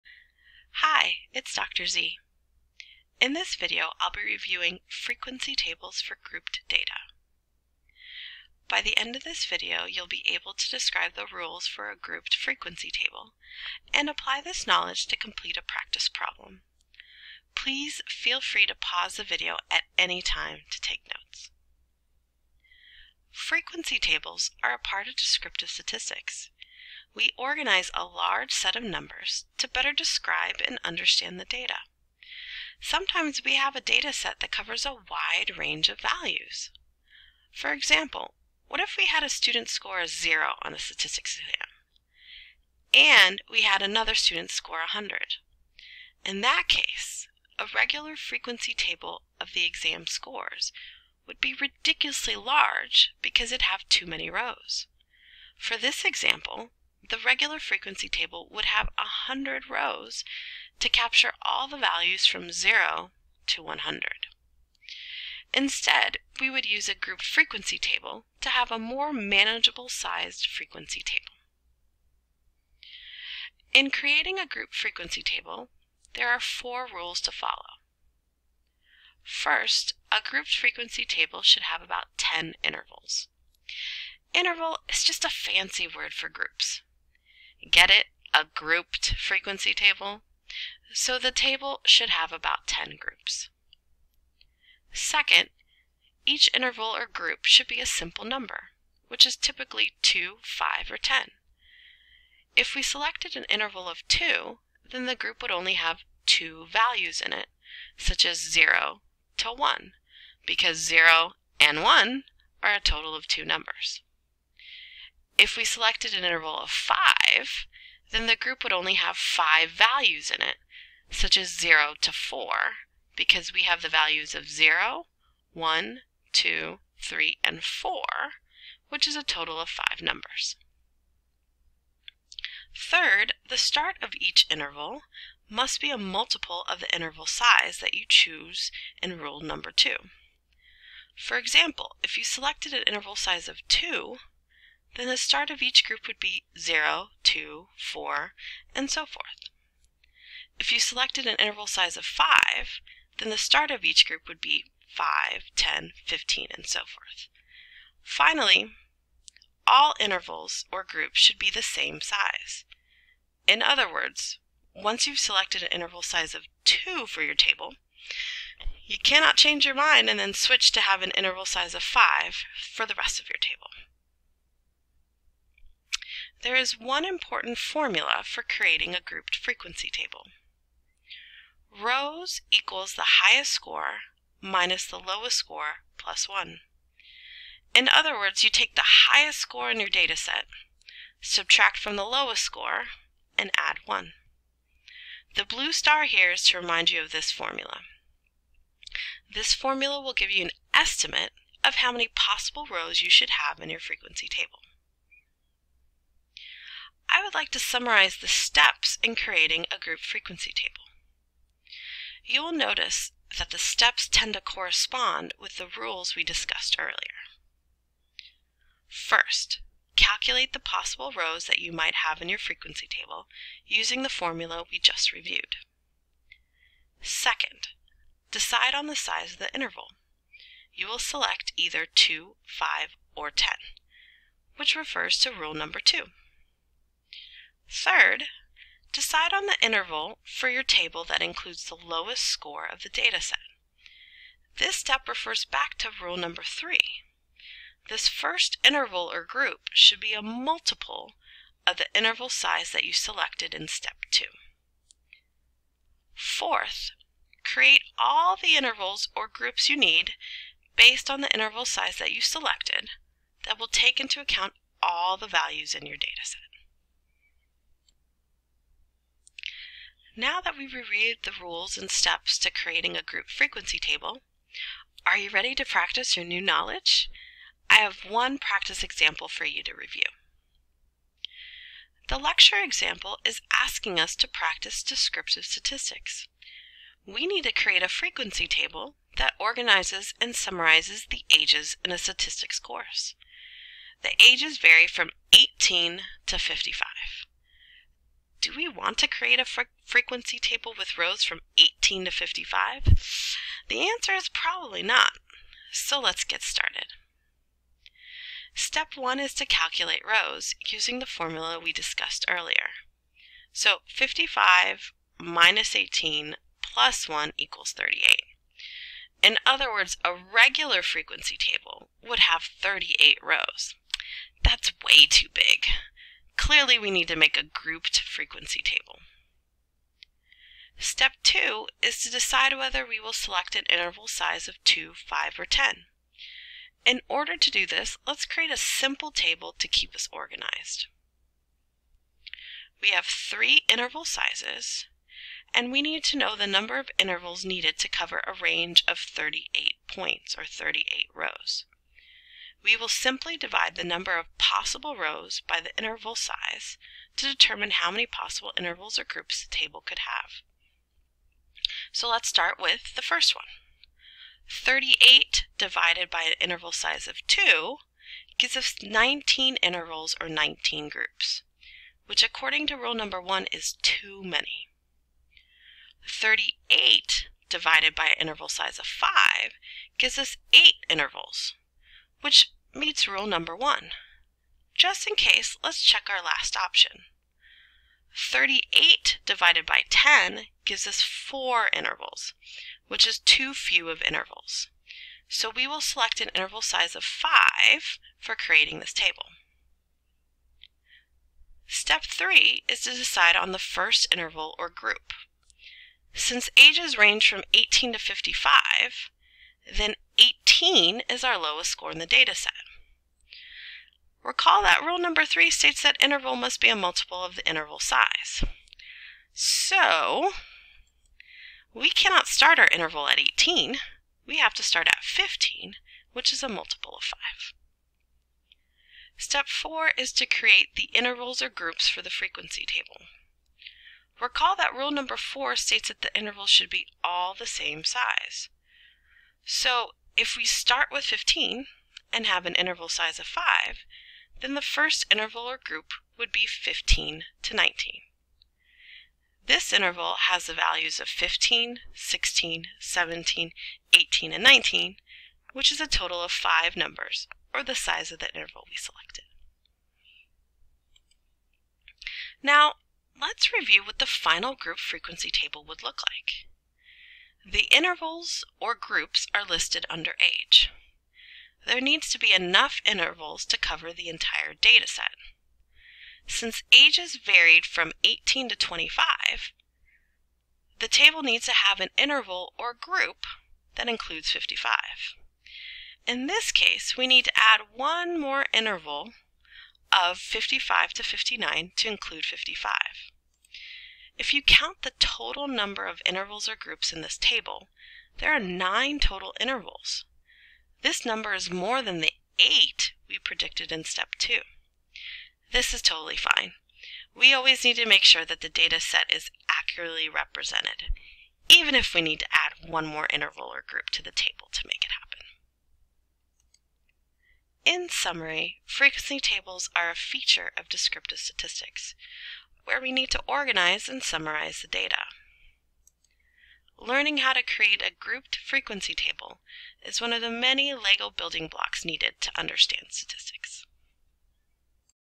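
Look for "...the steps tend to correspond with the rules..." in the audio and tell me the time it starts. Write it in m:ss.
3:33.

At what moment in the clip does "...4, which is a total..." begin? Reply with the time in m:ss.
2:07.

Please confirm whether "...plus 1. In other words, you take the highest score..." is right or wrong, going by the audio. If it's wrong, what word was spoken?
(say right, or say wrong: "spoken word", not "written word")
right.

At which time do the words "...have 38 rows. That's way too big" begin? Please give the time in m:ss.
5:22.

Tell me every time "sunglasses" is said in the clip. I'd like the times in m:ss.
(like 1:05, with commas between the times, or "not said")
not said.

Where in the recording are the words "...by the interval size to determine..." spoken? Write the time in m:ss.
5:55.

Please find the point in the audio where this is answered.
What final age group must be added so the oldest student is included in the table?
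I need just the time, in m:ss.
8:10.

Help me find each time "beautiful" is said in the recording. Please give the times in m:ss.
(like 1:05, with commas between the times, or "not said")
not said.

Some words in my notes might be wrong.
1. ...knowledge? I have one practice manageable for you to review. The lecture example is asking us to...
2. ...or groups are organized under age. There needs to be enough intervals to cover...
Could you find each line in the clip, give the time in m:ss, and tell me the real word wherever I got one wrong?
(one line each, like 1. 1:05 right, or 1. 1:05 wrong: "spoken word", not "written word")
1. 4:36 wrong: "example", not "manageable"
2. 7:48 wrong: "listed", not "organized".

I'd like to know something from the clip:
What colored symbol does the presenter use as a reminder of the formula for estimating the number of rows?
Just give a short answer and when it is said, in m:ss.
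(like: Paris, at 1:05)
blue star, at 3:15.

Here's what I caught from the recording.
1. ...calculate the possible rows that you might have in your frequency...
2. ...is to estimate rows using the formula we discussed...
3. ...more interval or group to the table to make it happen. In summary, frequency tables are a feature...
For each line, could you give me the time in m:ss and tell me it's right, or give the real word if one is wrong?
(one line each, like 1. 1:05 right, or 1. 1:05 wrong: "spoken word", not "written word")
1. 3:39 right
2. 5:09 wrong: "calculate", not "estimate"
3. 8:32 right.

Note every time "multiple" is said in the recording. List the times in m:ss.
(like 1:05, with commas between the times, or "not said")
2:15, 4:10, 6:56, 7:06.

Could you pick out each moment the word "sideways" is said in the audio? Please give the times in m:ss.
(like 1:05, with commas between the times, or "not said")
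not said.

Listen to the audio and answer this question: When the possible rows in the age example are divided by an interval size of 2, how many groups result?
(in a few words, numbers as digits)
19.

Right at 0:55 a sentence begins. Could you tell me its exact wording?
For this example, the regular frequency table would have 100 rows to capture all the values from 0 to 100.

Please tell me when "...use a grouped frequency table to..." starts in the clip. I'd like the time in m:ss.
1:06.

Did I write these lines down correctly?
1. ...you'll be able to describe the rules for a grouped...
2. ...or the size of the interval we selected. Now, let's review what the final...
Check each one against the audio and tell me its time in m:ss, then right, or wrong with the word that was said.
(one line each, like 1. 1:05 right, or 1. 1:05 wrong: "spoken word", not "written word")
1. 0:09 right
2. 7:37 right.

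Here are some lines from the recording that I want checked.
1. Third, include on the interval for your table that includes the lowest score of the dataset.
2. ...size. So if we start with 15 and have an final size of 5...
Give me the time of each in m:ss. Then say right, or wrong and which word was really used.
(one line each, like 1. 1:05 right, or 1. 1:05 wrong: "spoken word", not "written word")
1. 3:57 wrong: "decide", not "include"
2. 7:17 wrong: "interval", not "final".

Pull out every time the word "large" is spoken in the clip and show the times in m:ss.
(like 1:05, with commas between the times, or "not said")
0:28, 0:52.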